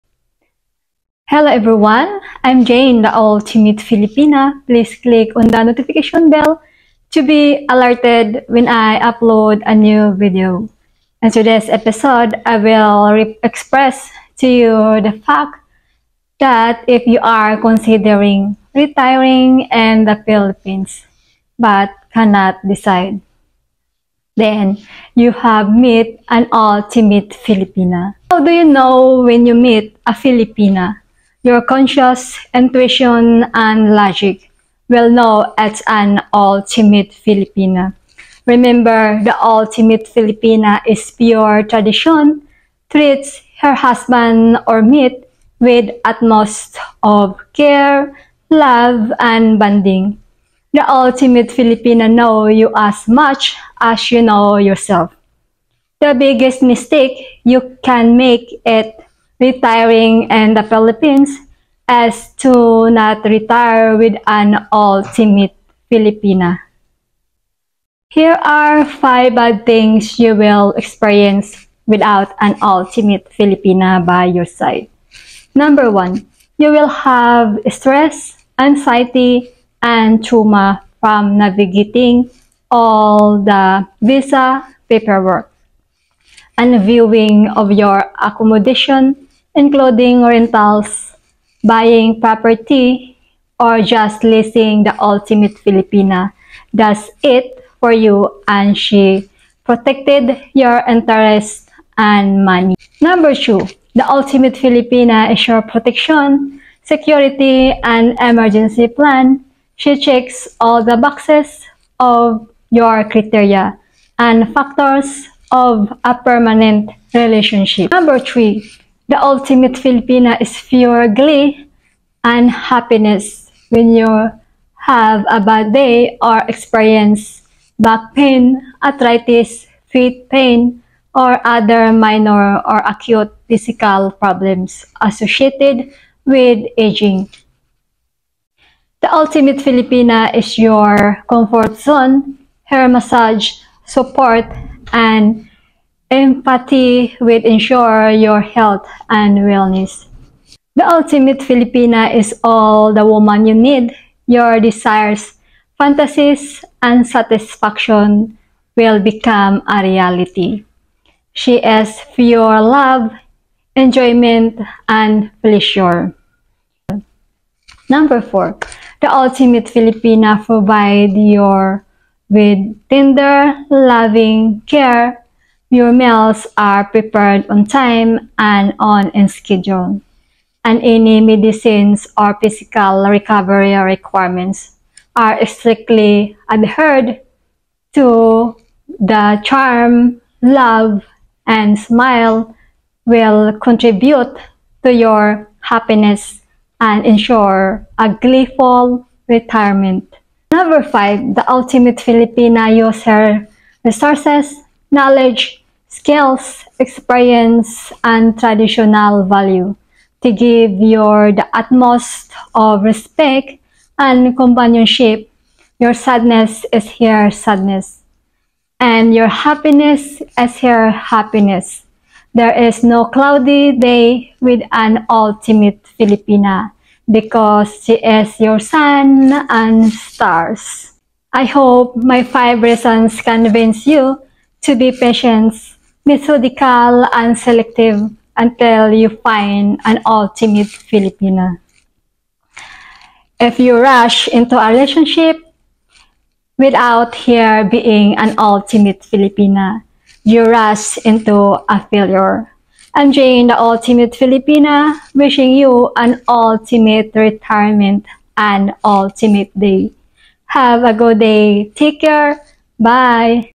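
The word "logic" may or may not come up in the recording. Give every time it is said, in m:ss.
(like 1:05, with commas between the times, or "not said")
0:33.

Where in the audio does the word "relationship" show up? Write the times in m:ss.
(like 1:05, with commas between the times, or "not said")
1:57, 4:04.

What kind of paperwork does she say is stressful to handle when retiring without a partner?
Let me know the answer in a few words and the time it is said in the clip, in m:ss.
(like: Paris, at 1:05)
visa paperwork, at 1:24.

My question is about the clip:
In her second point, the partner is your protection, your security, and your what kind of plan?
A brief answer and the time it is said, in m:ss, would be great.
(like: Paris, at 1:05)
emergency plan, at 1:48.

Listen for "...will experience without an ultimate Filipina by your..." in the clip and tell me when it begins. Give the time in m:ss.
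1:10.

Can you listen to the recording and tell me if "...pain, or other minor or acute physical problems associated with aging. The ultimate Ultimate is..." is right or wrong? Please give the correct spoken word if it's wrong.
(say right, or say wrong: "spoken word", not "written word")
wrong: "Filipina", not "Ultimate".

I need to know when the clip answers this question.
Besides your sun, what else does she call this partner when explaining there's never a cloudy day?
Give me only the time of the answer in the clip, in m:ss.
3:49.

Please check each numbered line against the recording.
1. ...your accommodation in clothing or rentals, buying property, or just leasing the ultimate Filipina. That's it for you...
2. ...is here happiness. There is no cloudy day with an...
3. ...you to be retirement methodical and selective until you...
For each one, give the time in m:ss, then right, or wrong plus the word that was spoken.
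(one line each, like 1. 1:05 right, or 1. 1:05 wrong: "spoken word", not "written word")
1. 1:27 right
2. 3:40 right
3. 3:53 wrong: "patient", not "retirement".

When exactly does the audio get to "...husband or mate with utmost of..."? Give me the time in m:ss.
0:43.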